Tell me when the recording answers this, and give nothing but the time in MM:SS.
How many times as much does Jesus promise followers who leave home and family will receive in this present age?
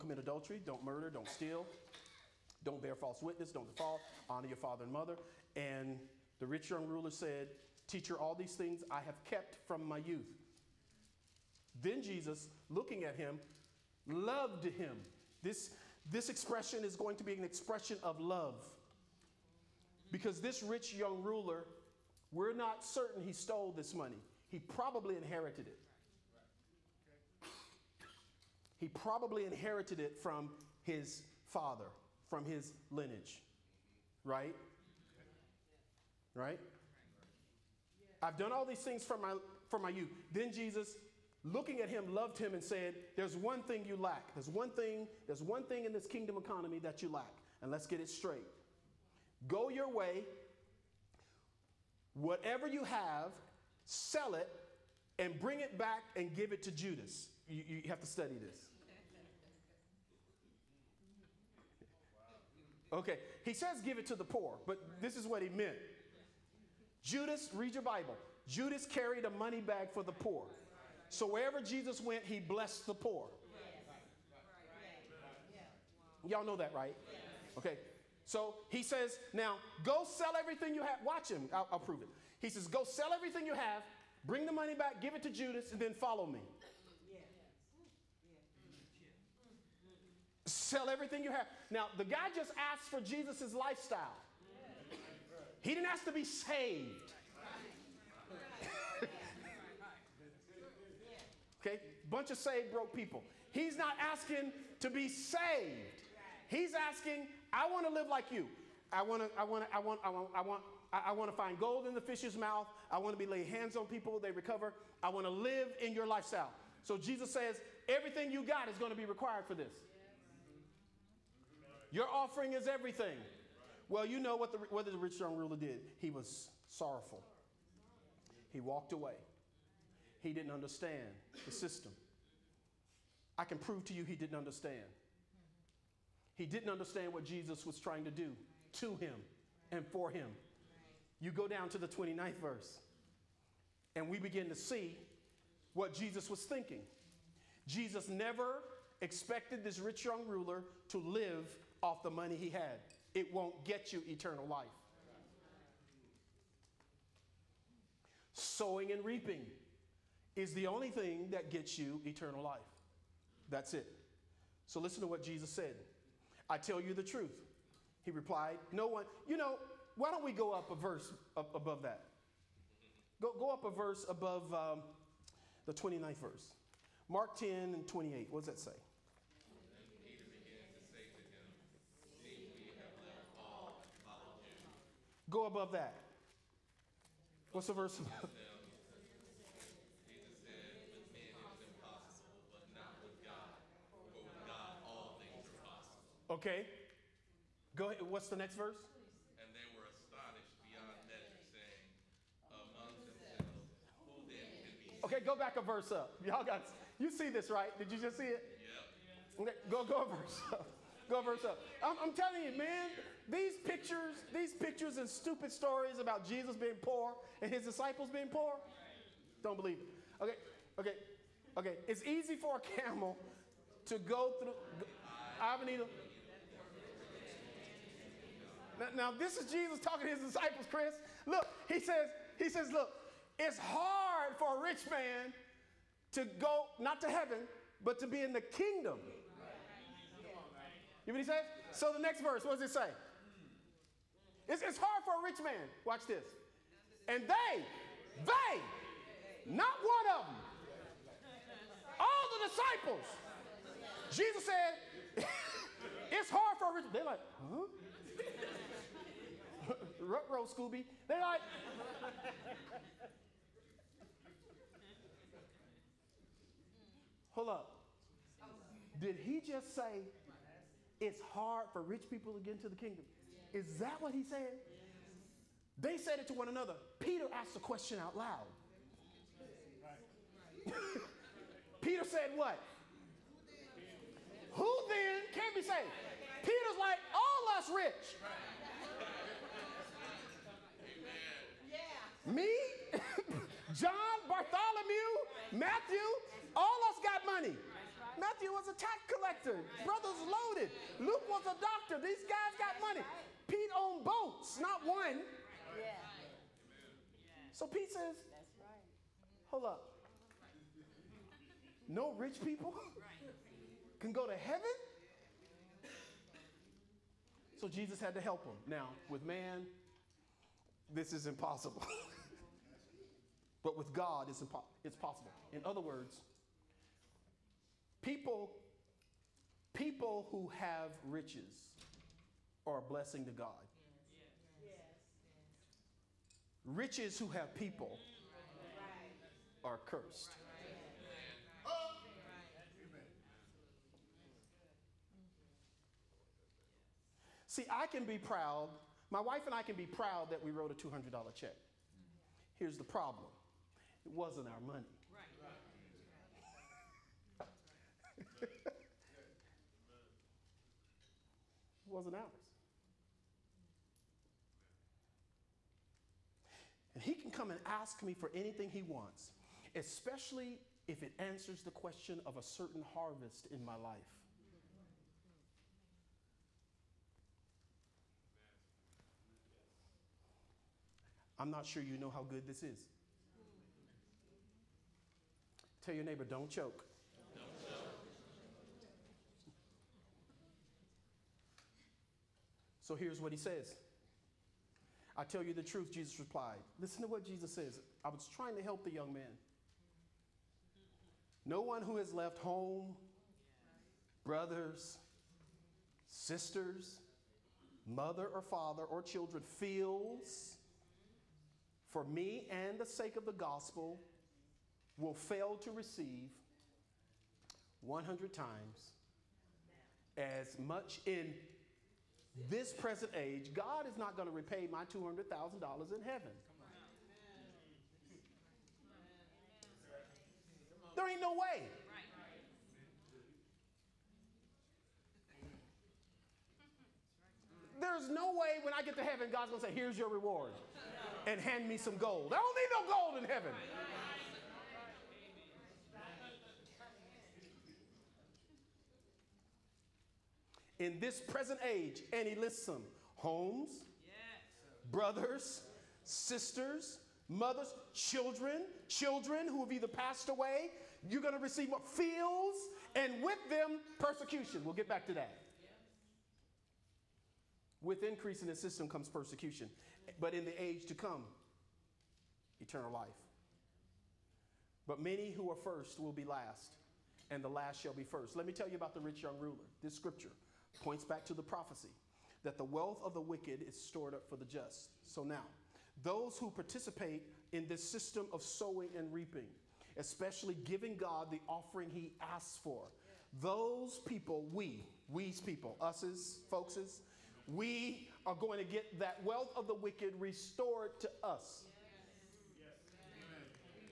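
06:57.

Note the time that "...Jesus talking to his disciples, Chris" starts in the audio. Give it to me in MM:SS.
03:49.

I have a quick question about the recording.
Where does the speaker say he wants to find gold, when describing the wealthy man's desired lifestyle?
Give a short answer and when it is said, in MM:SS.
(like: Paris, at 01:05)
fish's mouth, at 01:52.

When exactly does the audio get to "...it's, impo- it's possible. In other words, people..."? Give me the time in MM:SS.
05:24.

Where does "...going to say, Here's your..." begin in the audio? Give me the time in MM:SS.
07:19.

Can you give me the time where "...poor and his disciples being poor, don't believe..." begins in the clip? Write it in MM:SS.
03:36.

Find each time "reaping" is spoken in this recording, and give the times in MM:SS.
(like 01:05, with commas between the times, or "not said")
02:39, 08:09.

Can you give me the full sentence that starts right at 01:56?
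So Jesus says, everything you got is going to be required for this.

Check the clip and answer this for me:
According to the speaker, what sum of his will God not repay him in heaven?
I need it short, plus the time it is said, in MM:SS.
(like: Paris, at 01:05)
$200,000, at 07:04.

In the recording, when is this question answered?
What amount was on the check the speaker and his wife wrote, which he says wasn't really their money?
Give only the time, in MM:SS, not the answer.
05:50.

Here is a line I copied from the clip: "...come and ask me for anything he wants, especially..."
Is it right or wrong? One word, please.
right.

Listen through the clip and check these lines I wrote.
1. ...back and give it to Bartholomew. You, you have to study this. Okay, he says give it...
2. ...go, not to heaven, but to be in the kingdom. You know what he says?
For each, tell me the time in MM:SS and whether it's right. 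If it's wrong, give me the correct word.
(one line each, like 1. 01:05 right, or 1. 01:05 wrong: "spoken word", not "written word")
1. 00:55 wrong: "Judas", not "Bartholomew"
2. 03:56 right.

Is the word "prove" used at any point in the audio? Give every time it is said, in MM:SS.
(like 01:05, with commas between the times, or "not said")
01:21, 02:13.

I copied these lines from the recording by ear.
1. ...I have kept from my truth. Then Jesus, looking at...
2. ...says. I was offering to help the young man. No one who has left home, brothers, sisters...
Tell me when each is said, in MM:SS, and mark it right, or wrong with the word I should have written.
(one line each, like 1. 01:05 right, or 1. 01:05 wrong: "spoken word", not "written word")
1. 00:08 wrong: "youth", not "truth"
2. 06:37 wrong: "trying", not "offering".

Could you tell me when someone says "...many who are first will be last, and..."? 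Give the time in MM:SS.
07:54.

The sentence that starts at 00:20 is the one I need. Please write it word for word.
Because this rich young ruler, we're not certain he stole this money.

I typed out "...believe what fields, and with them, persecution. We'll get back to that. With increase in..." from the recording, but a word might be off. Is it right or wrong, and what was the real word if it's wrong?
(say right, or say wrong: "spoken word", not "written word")
wrong: "receive", not "believe".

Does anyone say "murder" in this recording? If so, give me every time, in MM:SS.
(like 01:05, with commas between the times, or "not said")
00:00.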